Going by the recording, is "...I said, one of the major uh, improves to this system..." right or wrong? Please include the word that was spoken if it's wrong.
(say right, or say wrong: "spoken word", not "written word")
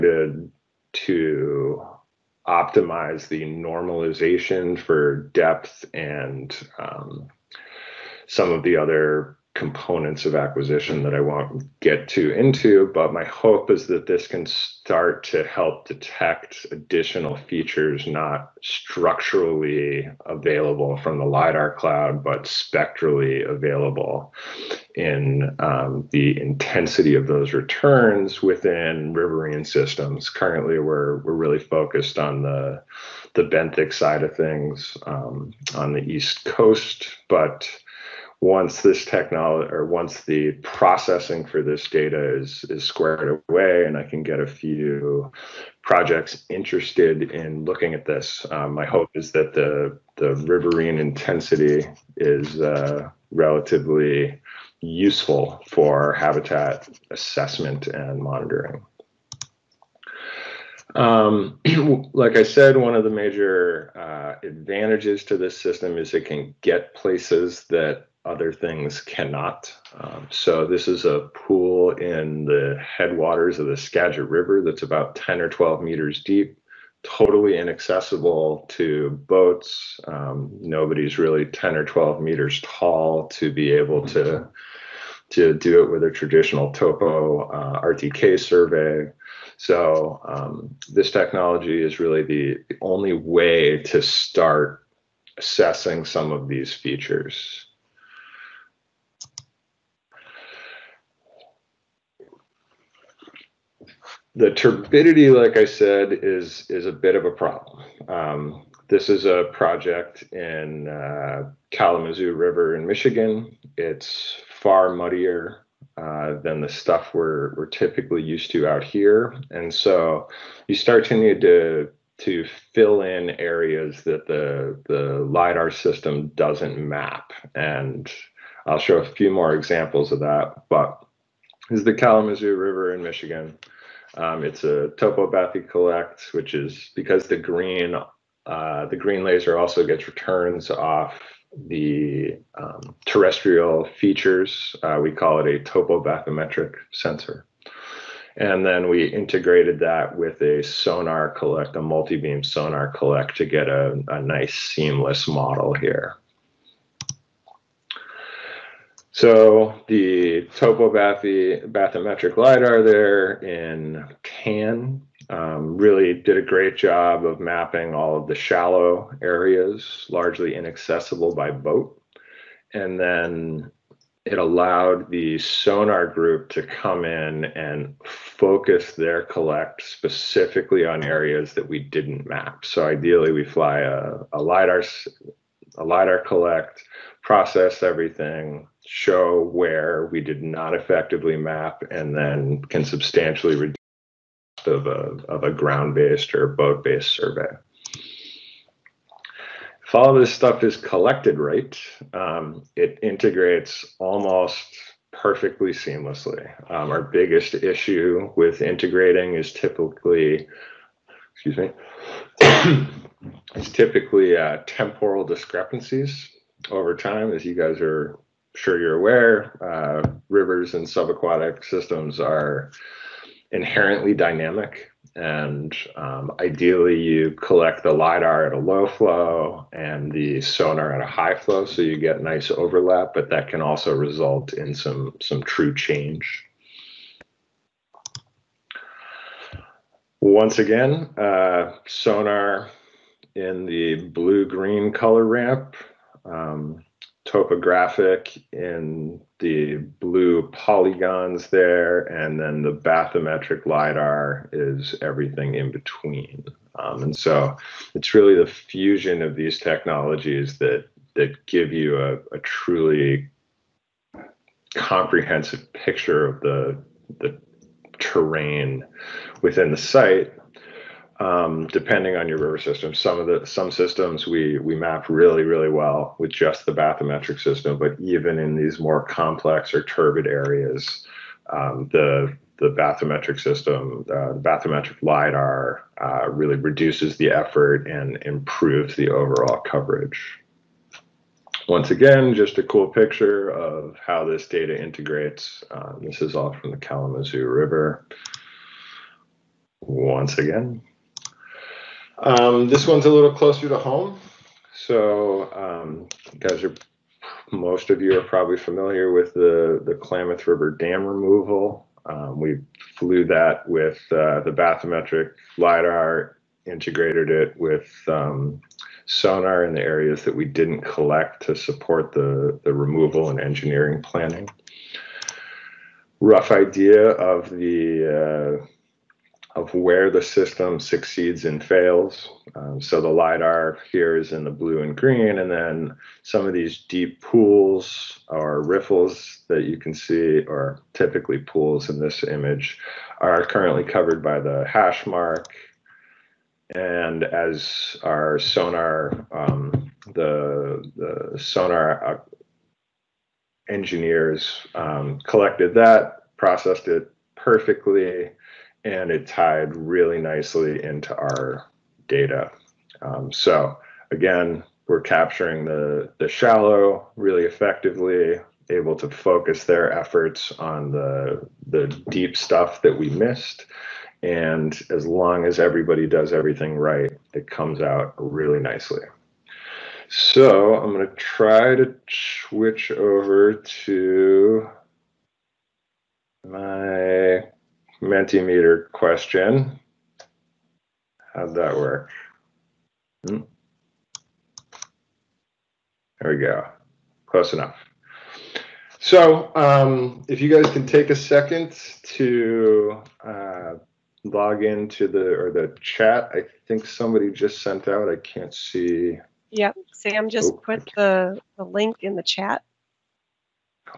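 wrong: "advantages", not "improves".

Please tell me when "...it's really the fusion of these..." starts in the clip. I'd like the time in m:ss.
4:17.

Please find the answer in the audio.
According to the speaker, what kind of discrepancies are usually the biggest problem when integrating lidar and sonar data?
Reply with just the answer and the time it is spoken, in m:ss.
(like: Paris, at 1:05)
temporal discrepancies, at 3:34.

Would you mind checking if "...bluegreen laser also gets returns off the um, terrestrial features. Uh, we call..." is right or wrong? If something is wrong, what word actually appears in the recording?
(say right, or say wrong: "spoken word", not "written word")
wrong: "green", not "bluegreen".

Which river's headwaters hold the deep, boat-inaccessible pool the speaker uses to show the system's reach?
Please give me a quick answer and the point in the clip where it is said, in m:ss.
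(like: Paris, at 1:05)
Skagit River, at 1:13.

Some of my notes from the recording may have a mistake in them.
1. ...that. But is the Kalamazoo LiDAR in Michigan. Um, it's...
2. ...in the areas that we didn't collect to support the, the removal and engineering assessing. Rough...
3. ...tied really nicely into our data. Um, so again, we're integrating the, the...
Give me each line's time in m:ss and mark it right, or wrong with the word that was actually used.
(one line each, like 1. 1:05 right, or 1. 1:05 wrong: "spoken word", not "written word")
1. 2:10 wrong: "River", not "LiDAR"
2. 5:19 wrong: "planning", not "assessing"
3. 5:59 wrong: "capturing", not "integrating".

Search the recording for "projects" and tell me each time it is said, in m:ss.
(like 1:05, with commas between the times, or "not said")
0:45, 1:49.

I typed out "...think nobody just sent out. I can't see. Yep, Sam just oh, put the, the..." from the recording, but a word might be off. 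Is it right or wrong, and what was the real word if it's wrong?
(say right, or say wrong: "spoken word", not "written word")
wrong: "somebody", not "nobody".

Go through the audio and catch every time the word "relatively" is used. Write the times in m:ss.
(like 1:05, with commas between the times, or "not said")
0:53.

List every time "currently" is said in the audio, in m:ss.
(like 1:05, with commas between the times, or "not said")
0:30, 5:43.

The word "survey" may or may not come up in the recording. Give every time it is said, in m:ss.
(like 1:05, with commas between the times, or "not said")
1:28, 3:17.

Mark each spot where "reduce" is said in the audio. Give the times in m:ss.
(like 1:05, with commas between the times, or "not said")
3:13, 4:46.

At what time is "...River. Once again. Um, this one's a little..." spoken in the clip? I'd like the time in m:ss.
4:57.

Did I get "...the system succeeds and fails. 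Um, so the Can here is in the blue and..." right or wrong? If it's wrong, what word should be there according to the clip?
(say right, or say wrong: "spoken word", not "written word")
wrong: "LIDAR", not "Can".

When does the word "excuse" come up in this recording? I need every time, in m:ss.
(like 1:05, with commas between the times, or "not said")
3:31.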